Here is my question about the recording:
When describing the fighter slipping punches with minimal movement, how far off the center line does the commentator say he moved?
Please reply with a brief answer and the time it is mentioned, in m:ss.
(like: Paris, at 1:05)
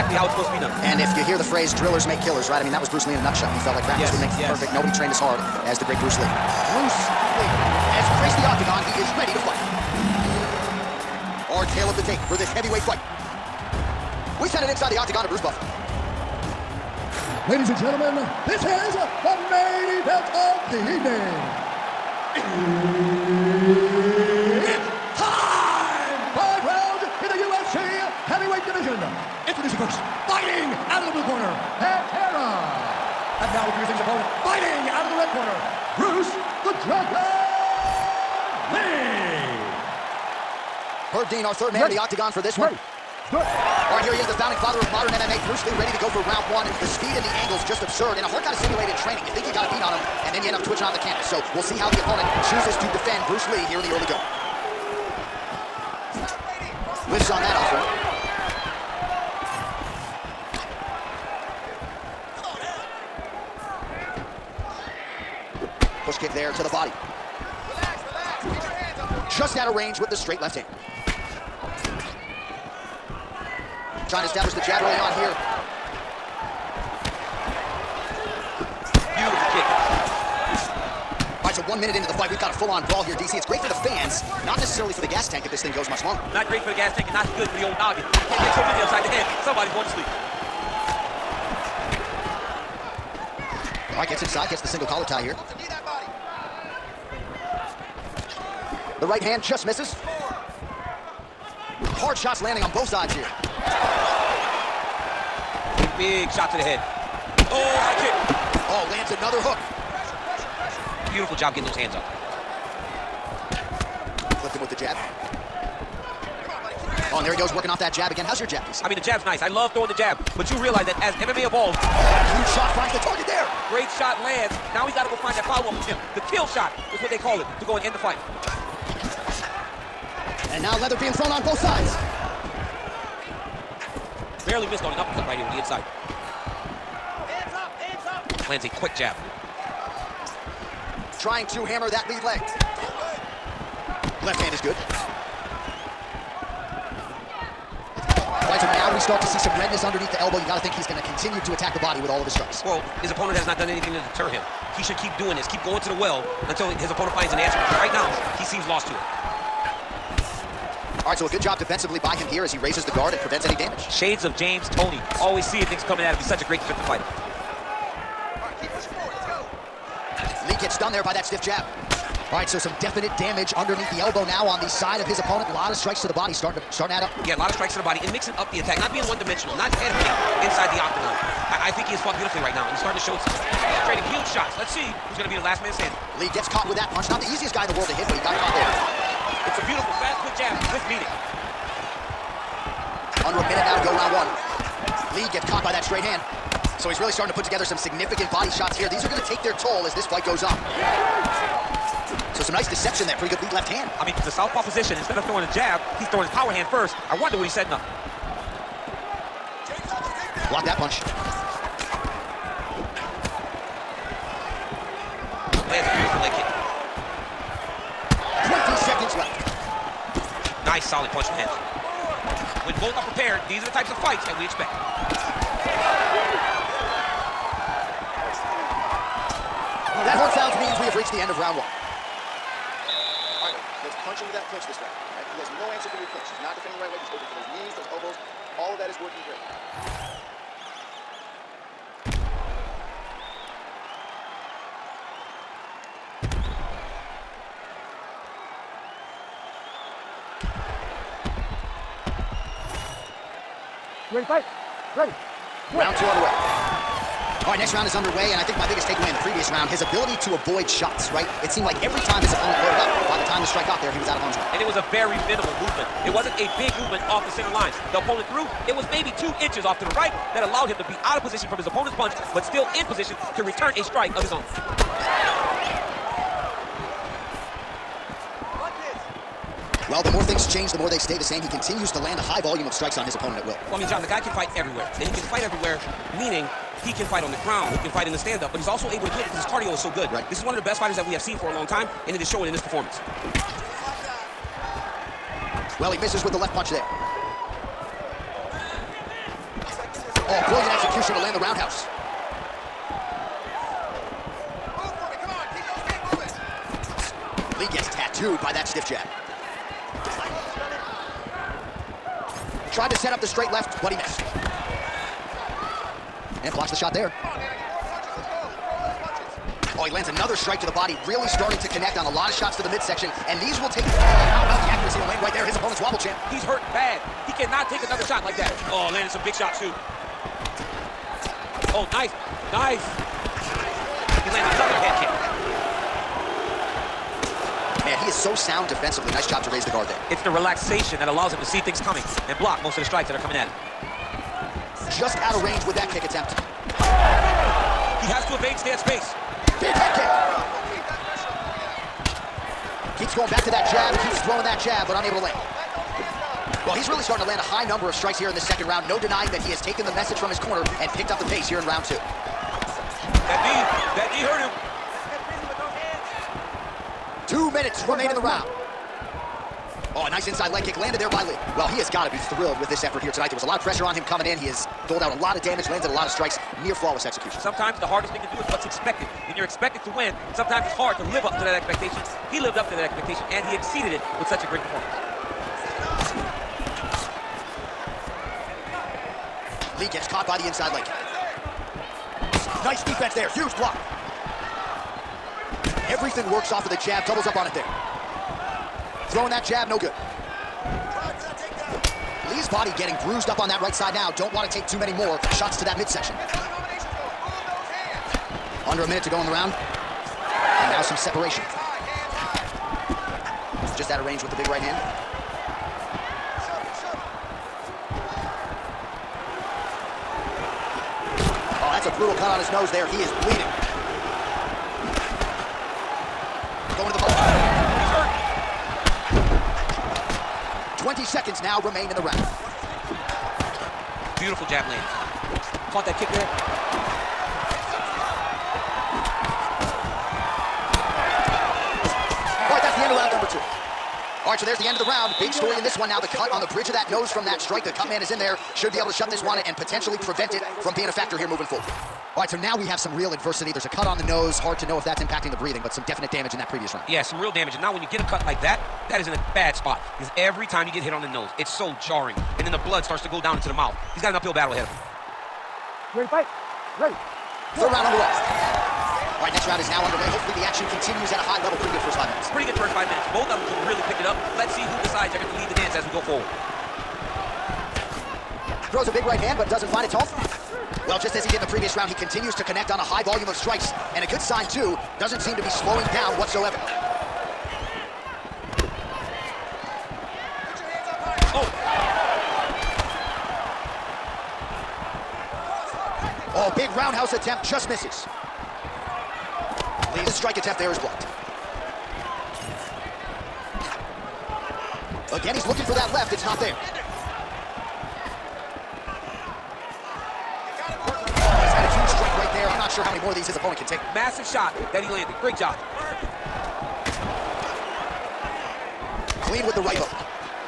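2 inches, at 4:29.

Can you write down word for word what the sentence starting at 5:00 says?
Oh, brilliant execution to land the roundhouse.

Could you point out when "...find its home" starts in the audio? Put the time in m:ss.
7:59.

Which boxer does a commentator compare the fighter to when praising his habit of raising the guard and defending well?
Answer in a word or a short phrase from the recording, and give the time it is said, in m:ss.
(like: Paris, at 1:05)
James Toney, at 2:44.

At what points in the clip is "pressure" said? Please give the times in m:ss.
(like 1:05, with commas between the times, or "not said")
6:13.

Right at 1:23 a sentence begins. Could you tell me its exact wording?
It's great for the fans, not necessarily for the gas tank if this thing goes much longer.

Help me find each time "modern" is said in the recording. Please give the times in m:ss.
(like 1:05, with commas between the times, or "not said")
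0:44.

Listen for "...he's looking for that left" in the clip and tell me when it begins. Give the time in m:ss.
8:25.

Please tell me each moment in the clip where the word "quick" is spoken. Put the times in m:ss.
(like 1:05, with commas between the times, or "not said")
2:18, 3:10.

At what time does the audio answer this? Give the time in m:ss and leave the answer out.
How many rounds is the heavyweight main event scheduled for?
0:26.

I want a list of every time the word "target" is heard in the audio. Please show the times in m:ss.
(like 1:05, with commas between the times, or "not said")
2:02.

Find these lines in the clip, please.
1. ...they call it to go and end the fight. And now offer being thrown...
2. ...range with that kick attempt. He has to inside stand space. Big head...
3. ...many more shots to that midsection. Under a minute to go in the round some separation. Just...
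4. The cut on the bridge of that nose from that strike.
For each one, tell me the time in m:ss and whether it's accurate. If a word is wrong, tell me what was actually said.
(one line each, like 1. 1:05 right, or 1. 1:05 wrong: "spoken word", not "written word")
1. 2:07 wrong: "leather", not "offer"
2. 5:45 wrong: "evade", not "inside"
3. 6:44 right
4. 7:25 right.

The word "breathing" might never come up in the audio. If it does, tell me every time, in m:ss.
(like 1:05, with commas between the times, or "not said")
7:35.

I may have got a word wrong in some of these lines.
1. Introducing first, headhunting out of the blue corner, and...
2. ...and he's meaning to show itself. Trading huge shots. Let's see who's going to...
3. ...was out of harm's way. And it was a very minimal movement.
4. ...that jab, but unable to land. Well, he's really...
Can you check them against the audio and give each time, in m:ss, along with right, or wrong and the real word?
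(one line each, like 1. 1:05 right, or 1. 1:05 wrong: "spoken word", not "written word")
1. 0:29 wrong: "fighting", not "headhunting"
2. 3:02 wrong: "starting", not "meaning"
3. 4:24 right
4. 5:54 right.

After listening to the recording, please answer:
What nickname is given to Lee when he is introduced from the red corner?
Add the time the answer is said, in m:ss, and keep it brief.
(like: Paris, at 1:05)
The Dragon, at 0:36.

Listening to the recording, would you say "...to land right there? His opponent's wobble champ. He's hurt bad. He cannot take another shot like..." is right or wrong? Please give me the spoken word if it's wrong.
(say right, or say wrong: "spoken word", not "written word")
right.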